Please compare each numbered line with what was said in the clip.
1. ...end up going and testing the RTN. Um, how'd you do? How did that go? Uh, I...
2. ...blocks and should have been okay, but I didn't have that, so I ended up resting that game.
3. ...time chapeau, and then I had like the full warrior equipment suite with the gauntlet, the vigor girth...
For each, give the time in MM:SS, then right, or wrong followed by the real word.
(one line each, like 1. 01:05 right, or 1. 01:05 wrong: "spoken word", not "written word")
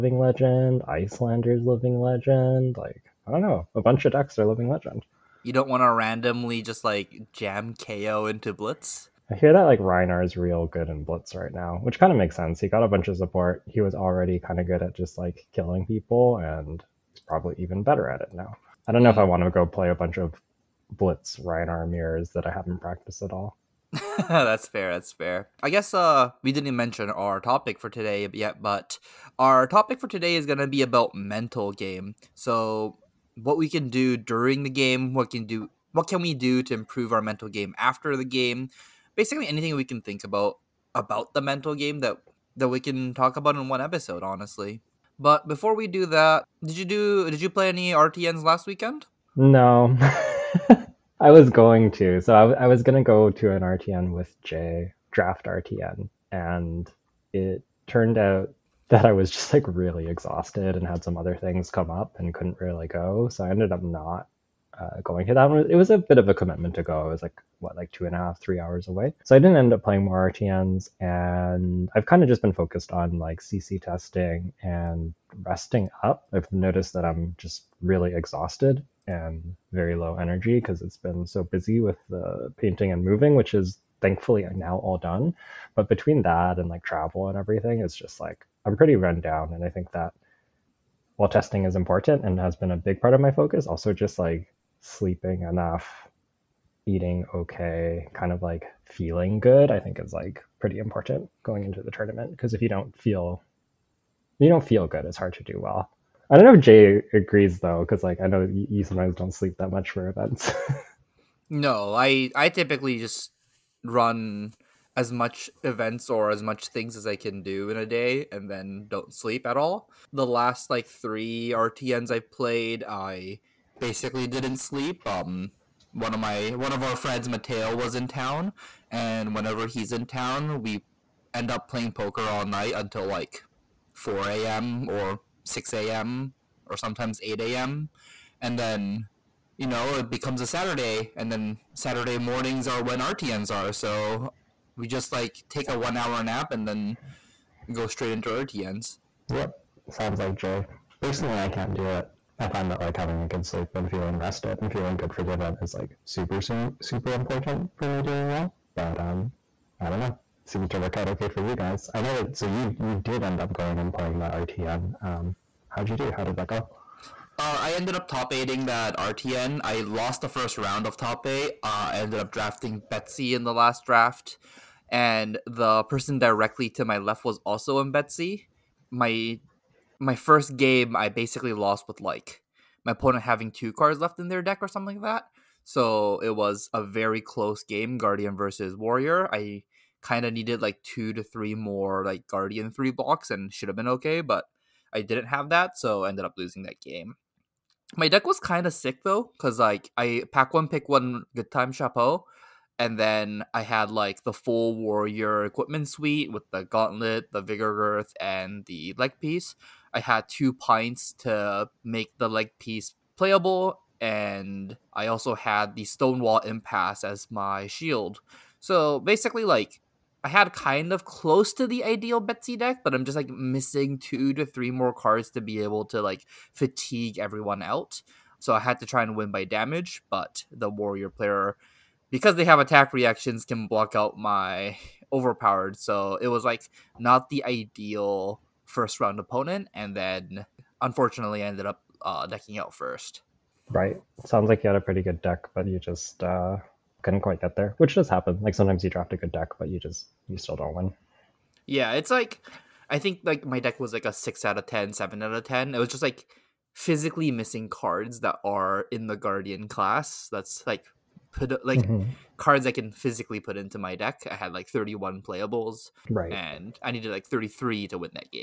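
1. 02:43 wrong: "playing", not "testing"
2. 03:12 wrong: "losing", not "resting"
3. 03:21 right.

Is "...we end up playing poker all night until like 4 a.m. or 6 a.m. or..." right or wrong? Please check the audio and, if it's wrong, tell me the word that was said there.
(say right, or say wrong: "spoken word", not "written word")
right.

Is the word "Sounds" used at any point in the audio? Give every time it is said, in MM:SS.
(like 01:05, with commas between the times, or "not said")
02:29, 04:04.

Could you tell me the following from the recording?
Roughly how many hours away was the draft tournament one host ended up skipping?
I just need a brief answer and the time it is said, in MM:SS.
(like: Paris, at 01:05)
2.5 to 3 hours, at 01:07.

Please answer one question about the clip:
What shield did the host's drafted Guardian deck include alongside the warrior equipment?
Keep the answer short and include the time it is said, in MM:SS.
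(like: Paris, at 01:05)
Stonewall Impasse, at 03:35.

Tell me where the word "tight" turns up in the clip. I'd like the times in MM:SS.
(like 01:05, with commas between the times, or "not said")
not said.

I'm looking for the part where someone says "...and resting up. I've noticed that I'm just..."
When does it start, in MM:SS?
01:14.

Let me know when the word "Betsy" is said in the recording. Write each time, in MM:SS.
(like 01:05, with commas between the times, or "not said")
02:52, 02:57, 03:42.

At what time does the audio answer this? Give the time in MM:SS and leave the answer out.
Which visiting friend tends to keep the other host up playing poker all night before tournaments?
02:07.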